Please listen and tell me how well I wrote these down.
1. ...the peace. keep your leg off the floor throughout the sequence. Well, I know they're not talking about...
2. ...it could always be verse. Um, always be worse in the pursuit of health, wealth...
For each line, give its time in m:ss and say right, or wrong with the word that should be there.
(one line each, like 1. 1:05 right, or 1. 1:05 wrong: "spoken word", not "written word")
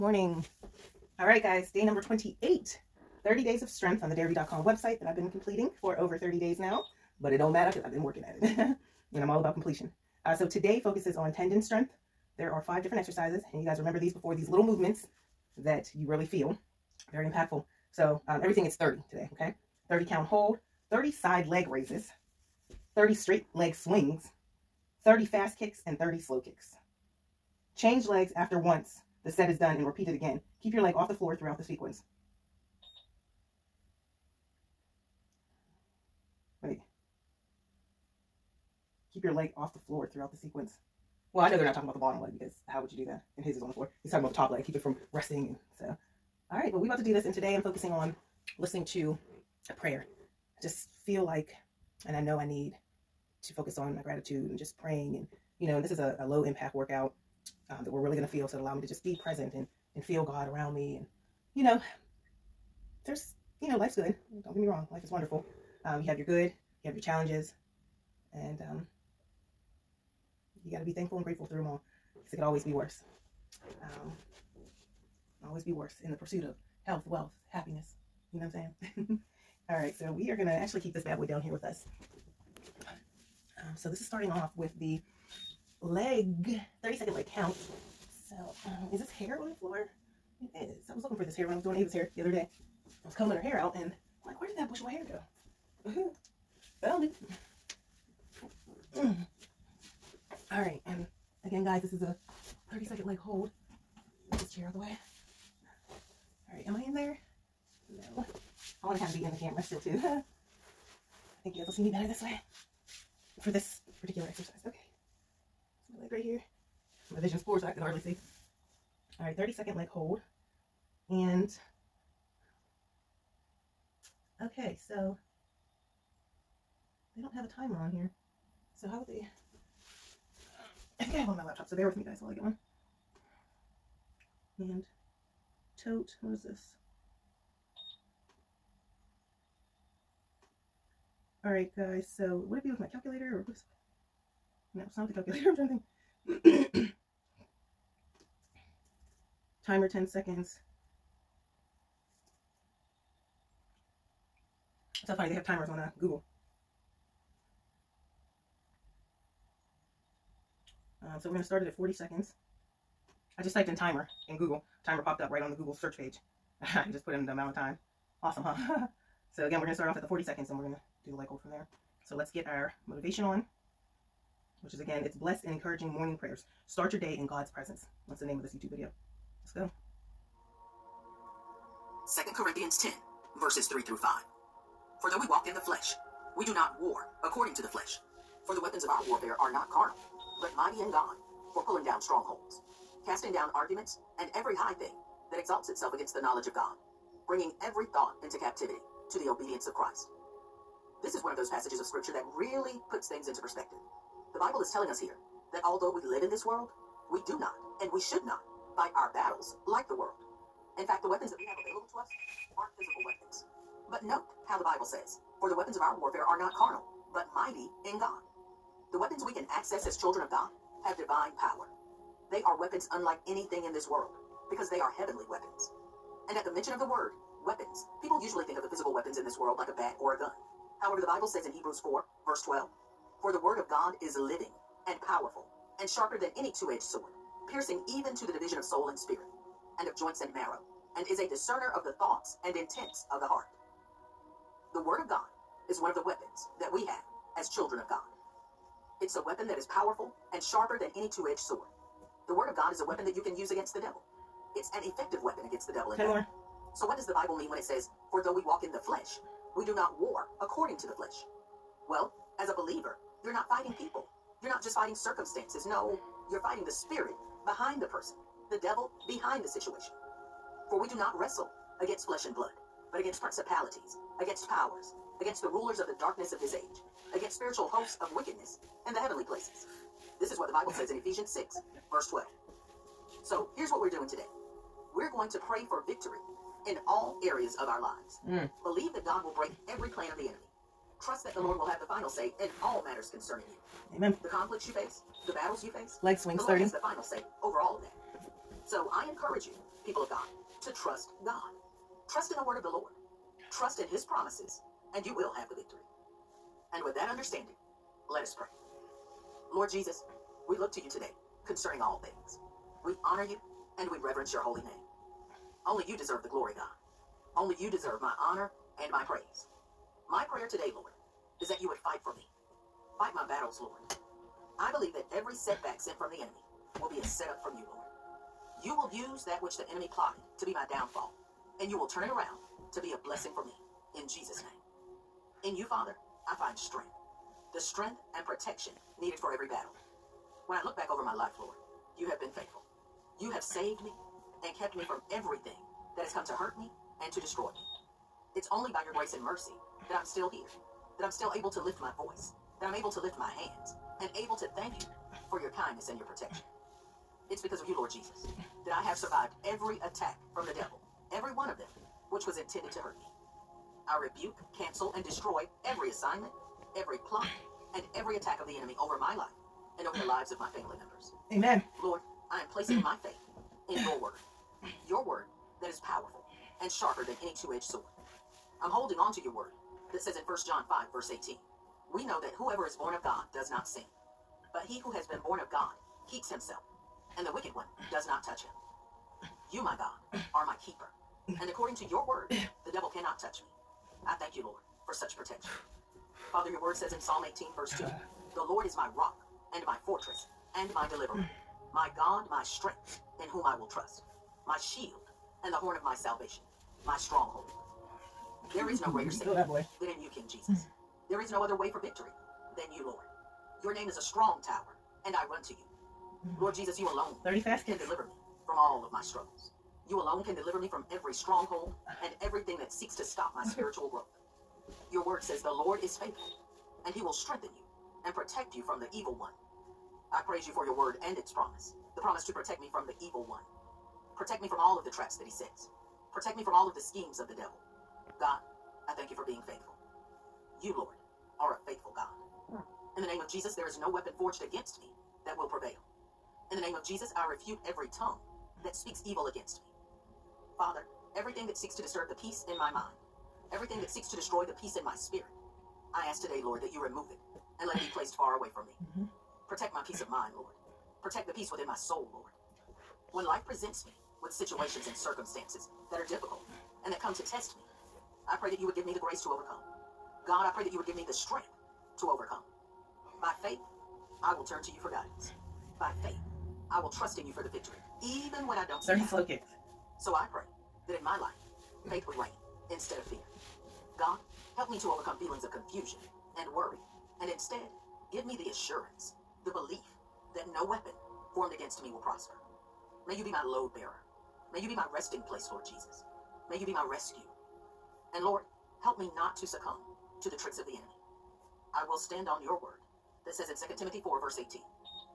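1. 0:31 wrong: "sequence", not "peace"
2. 1:12 wrong: "worse", not "verse".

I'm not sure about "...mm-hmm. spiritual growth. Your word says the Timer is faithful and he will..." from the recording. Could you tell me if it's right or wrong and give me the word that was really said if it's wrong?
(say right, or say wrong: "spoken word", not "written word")
wrong: "Lord", not "Timer".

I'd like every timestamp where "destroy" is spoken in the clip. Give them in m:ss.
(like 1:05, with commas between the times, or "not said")
5:47, 6:05, 7:34.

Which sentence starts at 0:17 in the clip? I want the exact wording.
So um, everything is 30 today, okay?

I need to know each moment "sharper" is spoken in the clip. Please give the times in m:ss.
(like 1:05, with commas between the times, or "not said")
3:55, 4:10, 6:16.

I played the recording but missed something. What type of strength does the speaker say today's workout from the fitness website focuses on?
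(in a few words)
tendon strength.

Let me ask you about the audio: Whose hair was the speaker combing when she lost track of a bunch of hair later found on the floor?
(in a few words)
Ava.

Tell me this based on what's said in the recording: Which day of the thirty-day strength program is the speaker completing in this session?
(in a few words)
28.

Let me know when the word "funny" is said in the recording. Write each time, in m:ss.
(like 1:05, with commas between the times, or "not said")
2:35.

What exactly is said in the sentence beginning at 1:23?
Um, so this is starting off with the leg, 30 second leg count.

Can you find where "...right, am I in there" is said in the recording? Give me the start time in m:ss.
1:46.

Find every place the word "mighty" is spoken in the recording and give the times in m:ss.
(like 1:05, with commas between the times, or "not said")
3:10, 3:37.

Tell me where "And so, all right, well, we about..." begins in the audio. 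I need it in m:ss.
0:45.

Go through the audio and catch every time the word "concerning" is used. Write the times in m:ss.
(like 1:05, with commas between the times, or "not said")
4:53, 5:11.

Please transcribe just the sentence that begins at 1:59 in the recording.
All right, 30 second leg hold.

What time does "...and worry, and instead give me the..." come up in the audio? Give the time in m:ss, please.
8:06.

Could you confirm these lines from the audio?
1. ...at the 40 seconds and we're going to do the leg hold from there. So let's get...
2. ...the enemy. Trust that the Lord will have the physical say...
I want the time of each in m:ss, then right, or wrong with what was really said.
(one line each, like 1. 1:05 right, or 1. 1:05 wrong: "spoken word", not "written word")
1. 2:49 right
2. 4:50 wrong: "final", not "physical".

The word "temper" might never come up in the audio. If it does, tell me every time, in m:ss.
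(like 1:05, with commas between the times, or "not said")
not said.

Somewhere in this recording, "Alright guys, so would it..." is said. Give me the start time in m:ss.
2:21.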